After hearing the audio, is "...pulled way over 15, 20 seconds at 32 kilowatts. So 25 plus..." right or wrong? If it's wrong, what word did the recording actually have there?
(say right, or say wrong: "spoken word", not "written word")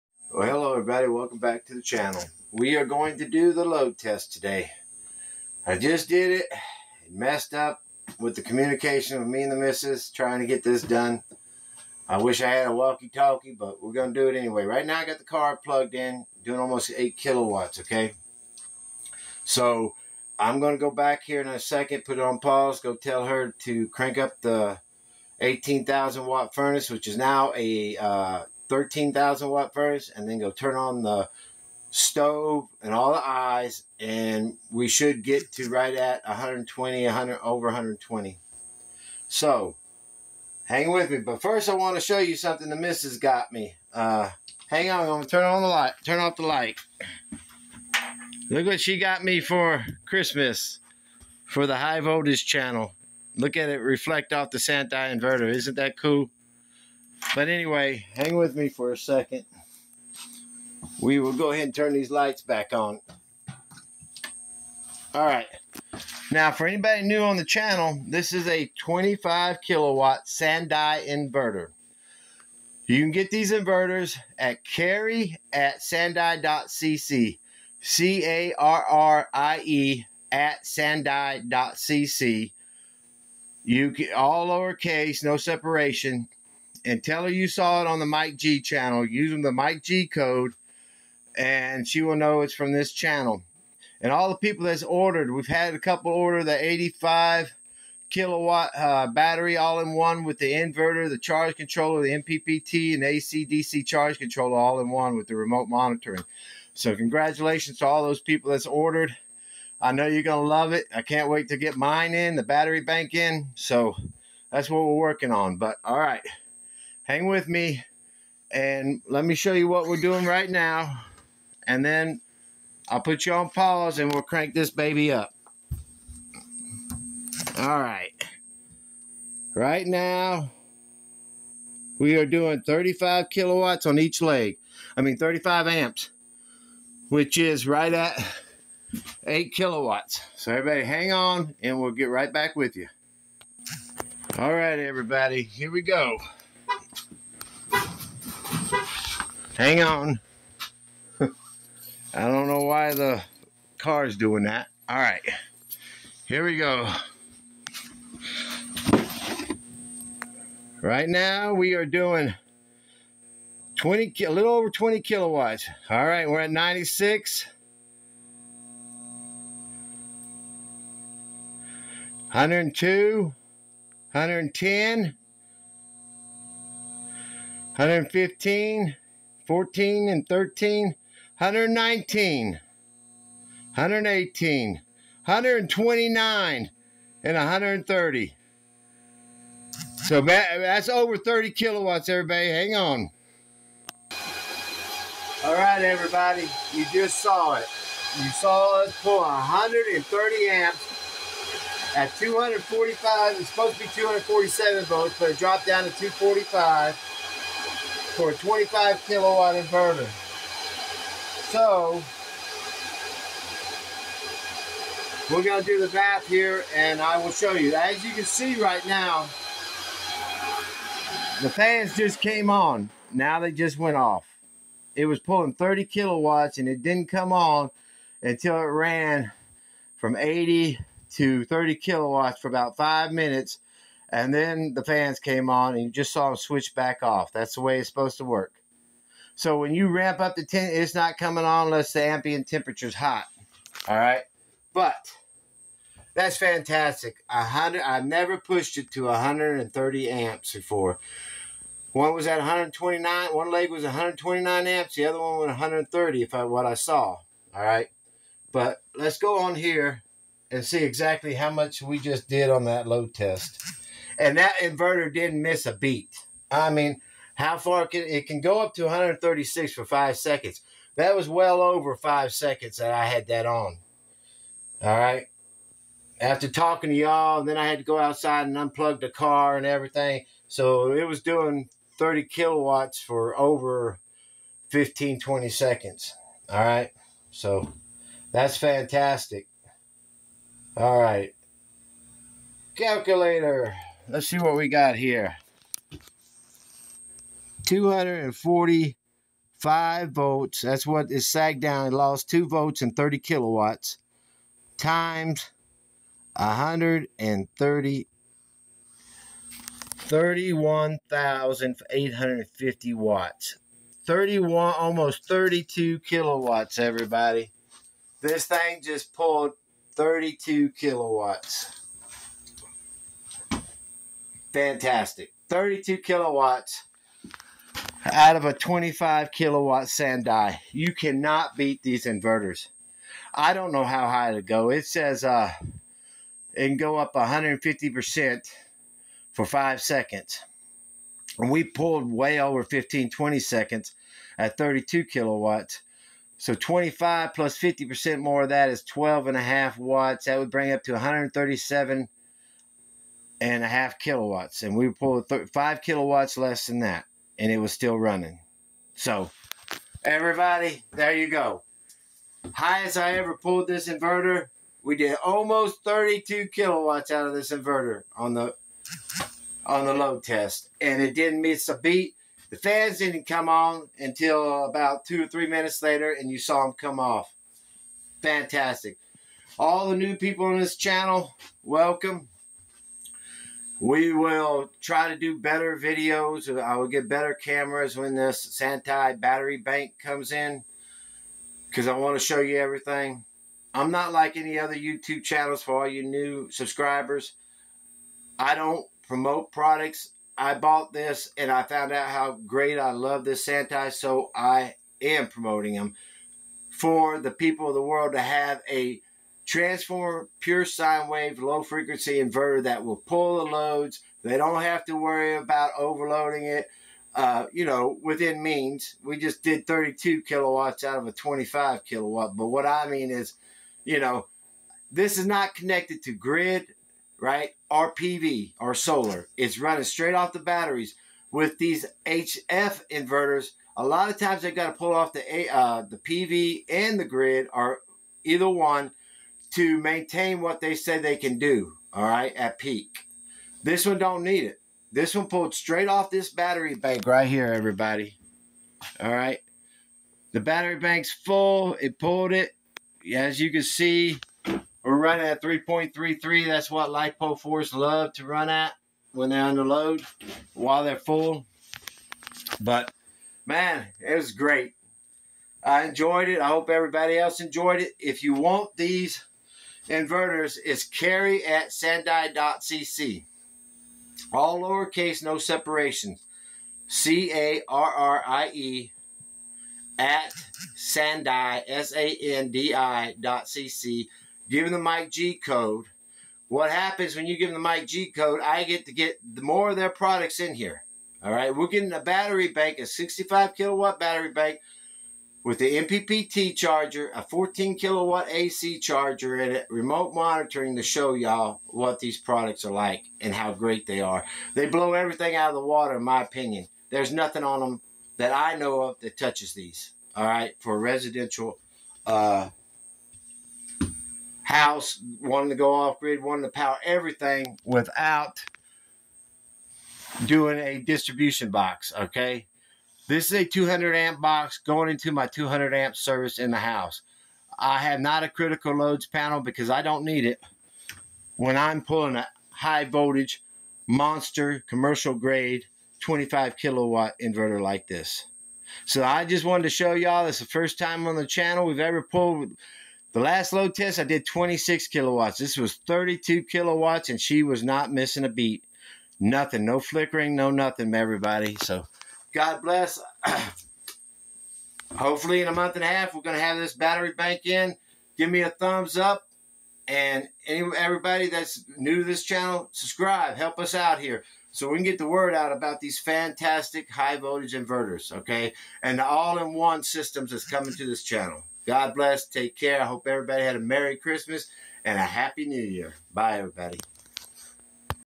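right.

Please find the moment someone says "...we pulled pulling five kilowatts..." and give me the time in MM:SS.
05:54.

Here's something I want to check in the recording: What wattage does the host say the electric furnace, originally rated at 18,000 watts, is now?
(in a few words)
13,000 watt.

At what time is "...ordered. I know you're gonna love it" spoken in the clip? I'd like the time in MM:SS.
01:48.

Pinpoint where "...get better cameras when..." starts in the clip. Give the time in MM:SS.
06:26.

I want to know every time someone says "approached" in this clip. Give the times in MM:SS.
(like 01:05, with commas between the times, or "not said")
not said.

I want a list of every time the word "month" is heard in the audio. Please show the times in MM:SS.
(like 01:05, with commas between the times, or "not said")
09:15.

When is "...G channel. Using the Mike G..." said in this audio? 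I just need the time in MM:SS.
01:28.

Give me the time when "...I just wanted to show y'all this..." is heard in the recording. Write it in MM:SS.
08:59.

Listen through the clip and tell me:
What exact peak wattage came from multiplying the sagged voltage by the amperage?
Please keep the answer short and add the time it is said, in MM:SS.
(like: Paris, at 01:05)
31,850 watts, at 05:09.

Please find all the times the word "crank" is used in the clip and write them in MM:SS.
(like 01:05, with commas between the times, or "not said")
00:23, 02:04.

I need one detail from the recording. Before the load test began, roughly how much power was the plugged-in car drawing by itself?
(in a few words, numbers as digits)
almost 8 kilowatts.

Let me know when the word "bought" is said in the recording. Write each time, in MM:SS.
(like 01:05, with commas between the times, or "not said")
06:40.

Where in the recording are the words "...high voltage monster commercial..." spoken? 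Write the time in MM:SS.
08:52.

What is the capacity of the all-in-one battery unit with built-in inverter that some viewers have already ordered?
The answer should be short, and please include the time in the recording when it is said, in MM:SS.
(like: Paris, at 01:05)
85 kilowatt, at 01:36.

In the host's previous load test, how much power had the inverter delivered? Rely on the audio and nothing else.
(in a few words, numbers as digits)
26 kilowatts.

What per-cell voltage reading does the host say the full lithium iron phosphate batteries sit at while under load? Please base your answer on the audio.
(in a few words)
3.33.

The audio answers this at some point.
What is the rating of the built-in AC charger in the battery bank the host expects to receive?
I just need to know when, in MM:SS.
08:17.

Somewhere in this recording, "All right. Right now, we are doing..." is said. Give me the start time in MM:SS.
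02:07.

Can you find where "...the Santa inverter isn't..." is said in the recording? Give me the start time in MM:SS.
00:54.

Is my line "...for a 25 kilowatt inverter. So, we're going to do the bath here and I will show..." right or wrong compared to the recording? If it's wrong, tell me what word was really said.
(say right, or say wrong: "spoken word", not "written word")
right.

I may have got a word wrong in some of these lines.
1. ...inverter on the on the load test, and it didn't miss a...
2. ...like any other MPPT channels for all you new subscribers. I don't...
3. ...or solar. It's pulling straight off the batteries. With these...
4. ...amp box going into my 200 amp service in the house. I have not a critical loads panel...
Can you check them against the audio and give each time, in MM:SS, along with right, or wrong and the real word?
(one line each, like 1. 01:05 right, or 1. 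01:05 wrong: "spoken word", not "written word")
1. 06:07 right
2. 06:34 wrong: "YouTube", not "MPPT"
3. 07:08 wrong: "running", not "pulling"
4. 08:43 right.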